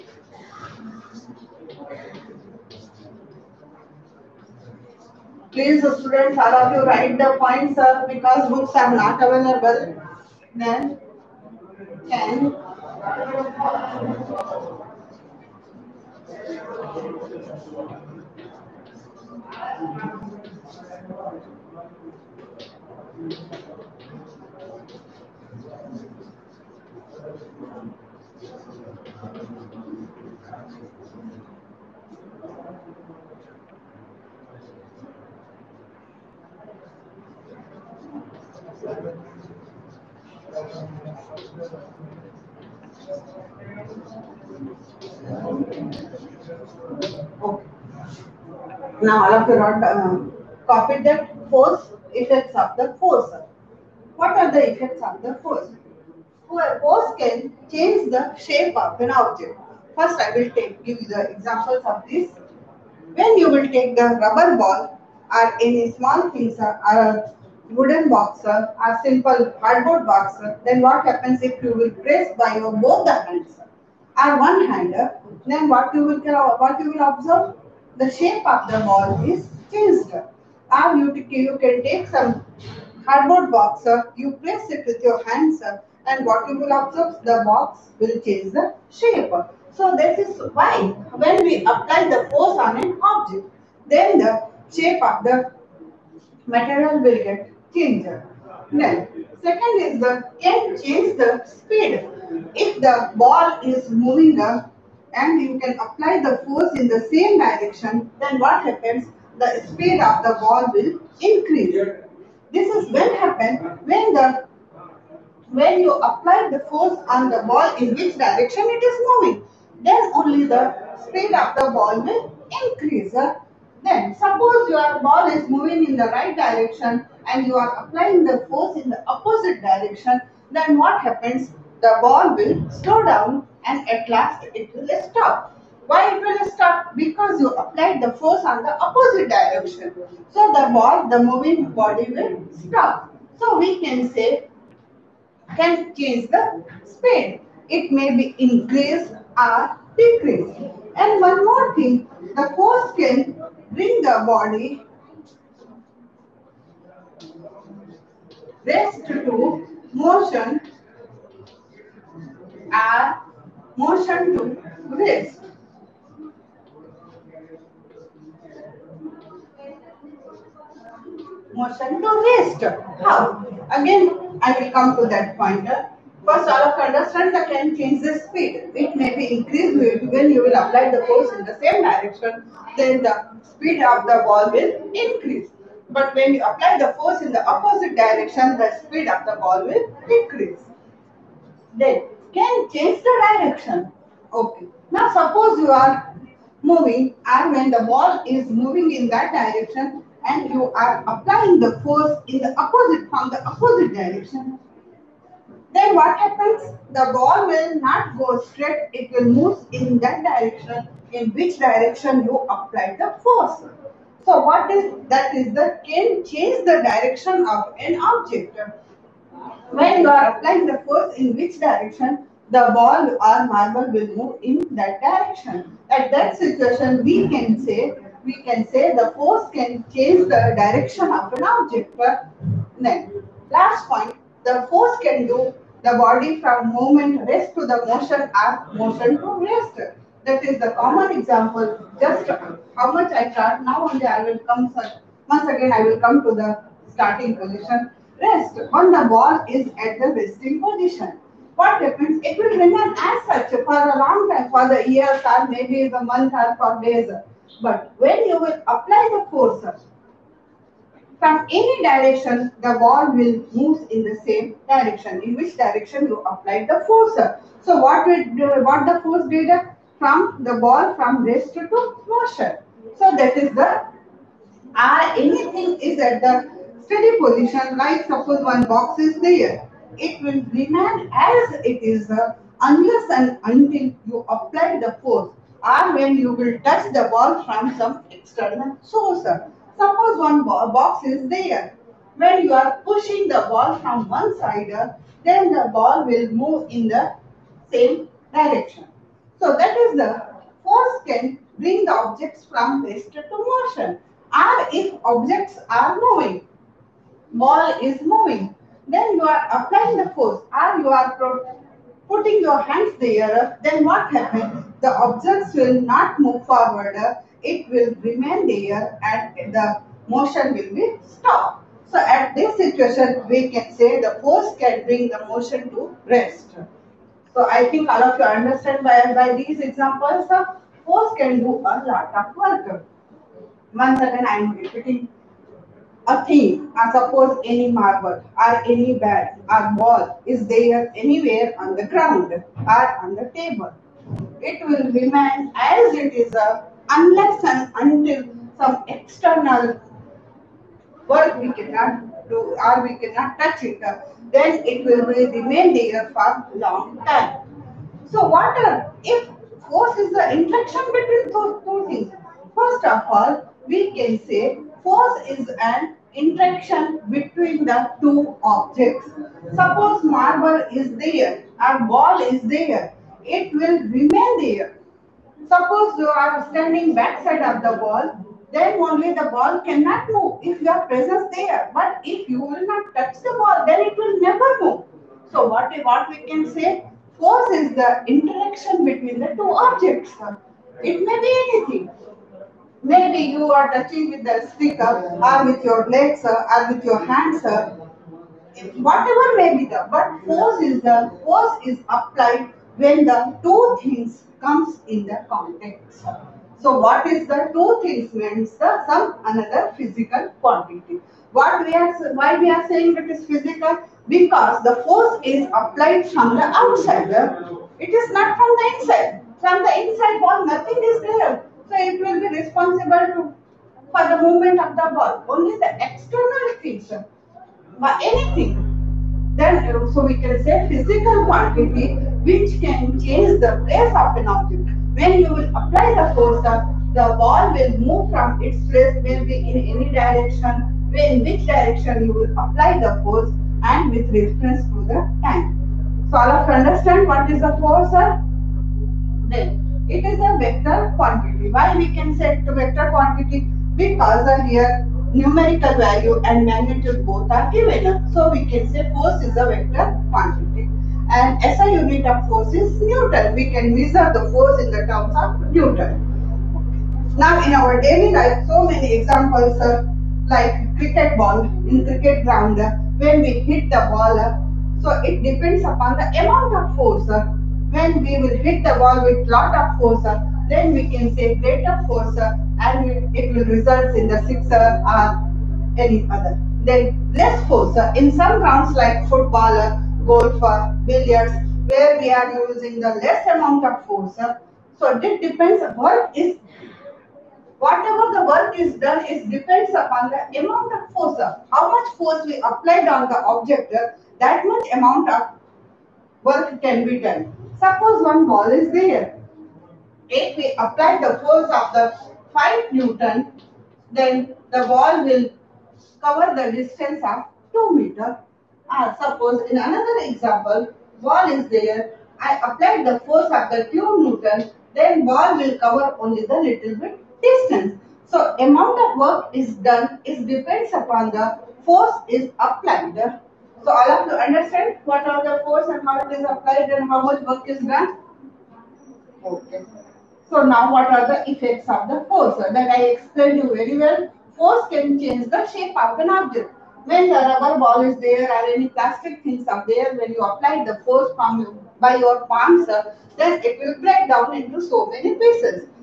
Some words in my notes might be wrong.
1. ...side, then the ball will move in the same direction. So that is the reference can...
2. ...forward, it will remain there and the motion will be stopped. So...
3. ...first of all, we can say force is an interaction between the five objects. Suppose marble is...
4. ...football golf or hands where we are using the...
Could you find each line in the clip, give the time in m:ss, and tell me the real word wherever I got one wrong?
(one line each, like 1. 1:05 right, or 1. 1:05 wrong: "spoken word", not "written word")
1. 4:54 wrong: "force", not "reference"
2. 5:16 right
3. 6:02 wrong: "two", not "five"
4. 8:09 wrong: "billiards", not "hands".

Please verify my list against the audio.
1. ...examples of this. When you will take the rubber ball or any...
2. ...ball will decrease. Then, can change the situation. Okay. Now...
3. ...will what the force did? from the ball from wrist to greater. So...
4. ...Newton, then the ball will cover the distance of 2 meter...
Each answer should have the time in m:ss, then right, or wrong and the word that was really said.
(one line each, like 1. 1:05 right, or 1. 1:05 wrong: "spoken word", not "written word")
1. 1:01 right
2. 3:09 wrong: "direction", not "situation"
3. 4:28 wrong: "washer", not "greater"
4. 8:32 right.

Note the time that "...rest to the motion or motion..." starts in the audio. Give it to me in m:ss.
3:57.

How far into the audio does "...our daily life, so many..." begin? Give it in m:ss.
7:47.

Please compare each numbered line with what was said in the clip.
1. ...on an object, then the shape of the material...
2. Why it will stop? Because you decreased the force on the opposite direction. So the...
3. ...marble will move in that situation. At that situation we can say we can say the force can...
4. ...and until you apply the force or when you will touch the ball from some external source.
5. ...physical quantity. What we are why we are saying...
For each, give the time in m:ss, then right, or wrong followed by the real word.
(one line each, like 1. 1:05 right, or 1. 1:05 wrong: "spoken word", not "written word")
1. 1:32 right
2. 2:15 wrong: "applied", not "decreased"
3. 3:43 wrong: "direction", not "situation"
4. 4:43 right
5. 6:49 right.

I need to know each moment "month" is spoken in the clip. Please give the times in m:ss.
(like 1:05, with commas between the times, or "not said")
4:16.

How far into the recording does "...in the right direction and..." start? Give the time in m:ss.
2:05.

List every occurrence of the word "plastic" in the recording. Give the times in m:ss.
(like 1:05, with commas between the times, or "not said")
9:08.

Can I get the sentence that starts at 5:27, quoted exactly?
So I think all of you understand by, by these examples, the force can do a lot of work.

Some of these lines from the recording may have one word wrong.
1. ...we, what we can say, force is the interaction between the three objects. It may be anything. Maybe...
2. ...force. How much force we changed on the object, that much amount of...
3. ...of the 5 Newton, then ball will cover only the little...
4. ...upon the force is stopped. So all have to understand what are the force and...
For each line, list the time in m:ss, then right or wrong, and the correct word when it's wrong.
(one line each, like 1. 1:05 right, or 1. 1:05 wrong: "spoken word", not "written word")
1. 6:25 wrong: "two", not "three"
2. 8:20 wrong: "applied", not "changed"
3. 8:43 wrong: "2", not "5"
4. 8:50 wrong: "applied", not "stopped".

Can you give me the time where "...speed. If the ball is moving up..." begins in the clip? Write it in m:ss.
1:41.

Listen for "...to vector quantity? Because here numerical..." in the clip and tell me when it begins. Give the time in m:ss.
7:32.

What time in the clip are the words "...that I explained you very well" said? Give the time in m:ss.
9:02.